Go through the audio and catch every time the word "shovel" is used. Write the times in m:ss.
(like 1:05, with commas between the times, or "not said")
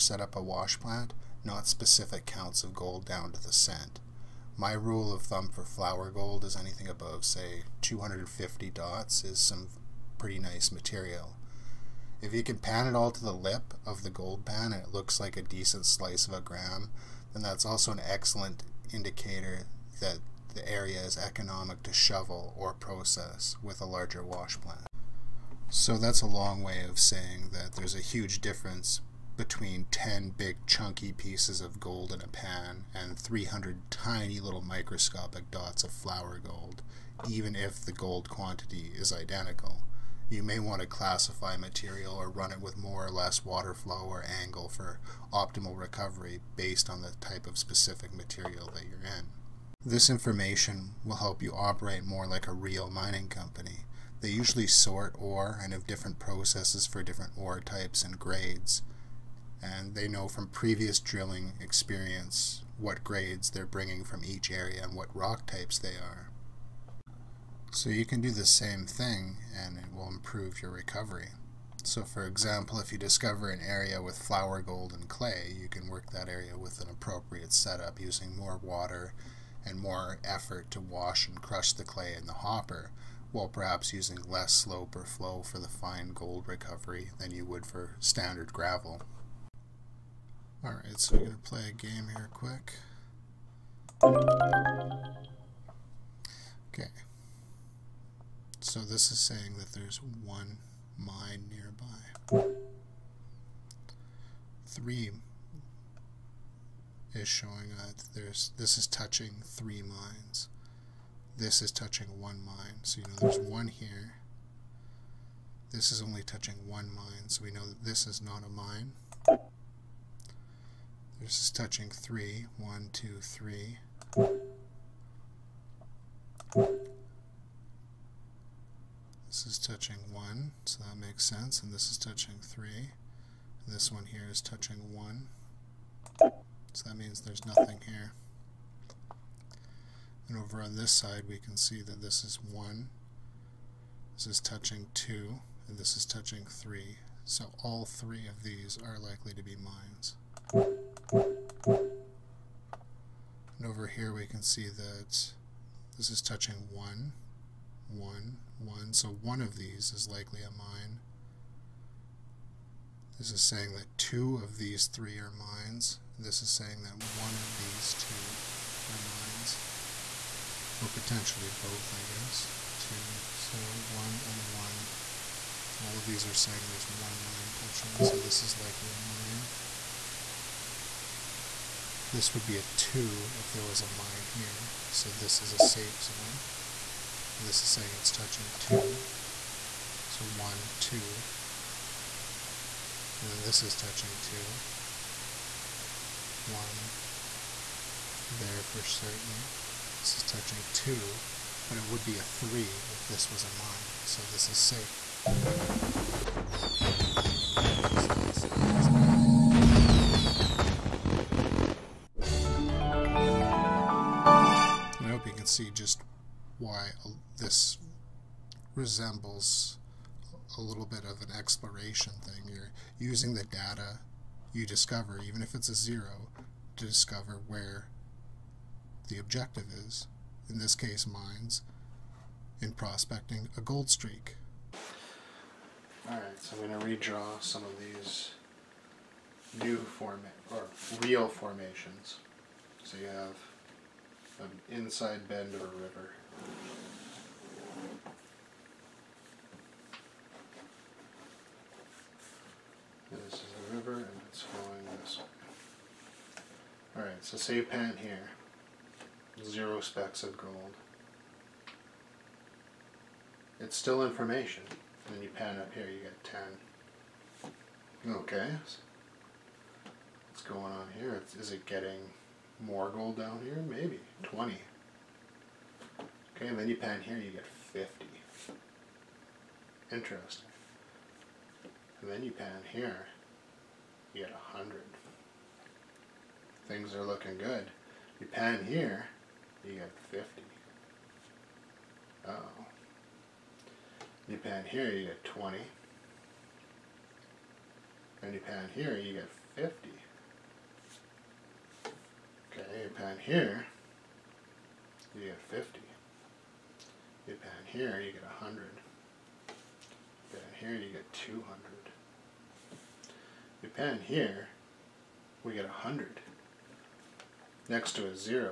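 0:21.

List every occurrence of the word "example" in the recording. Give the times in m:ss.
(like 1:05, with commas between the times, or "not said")
1:12.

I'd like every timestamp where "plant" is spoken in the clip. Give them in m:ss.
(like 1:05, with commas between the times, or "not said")
0:00, 0:24.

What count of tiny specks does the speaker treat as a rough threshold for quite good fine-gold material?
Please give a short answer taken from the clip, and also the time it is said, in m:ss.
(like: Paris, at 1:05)
250, at 0:07.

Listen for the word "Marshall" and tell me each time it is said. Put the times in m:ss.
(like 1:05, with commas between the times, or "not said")
not said.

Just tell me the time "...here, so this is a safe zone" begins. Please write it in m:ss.
3:04.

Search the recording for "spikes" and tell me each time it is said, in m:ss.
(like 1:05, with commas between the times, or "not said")
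not said.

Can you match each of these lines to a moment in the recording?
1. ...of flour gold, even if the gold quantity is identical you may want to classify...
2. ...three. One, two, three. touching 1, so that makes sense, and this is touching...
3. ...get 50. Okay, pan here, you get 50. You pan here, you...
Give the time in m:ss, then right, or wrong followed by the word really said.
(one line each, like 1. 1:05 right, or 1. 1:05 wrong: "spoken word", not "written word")
1. 0:35 right
2. 2:01 right
3. 4:59 right.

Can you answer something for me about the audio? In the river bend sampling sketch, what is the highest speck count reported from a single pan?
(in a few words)
200.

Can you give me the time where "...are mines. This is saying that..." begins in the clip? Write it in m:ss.
2:45.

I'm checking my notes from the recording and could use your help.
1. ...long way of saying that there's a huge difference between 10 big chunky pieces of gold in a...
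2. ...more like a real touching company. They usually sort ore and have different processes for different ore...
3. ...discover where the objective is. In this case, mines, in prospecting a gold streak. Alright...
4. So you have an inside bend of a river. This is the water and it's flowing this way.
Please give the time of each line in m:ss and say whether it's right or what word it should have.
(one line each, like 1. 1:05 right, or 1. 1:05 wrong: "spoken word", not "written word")
1. 0:26 right
2. 0:52 wrong: "mining", not "touching"
3. 3:46 right
4. 4:02 wrong: "river", not "water".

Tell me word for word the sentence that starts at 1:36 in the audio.
Okay, so this is saying that there's one mine nearby.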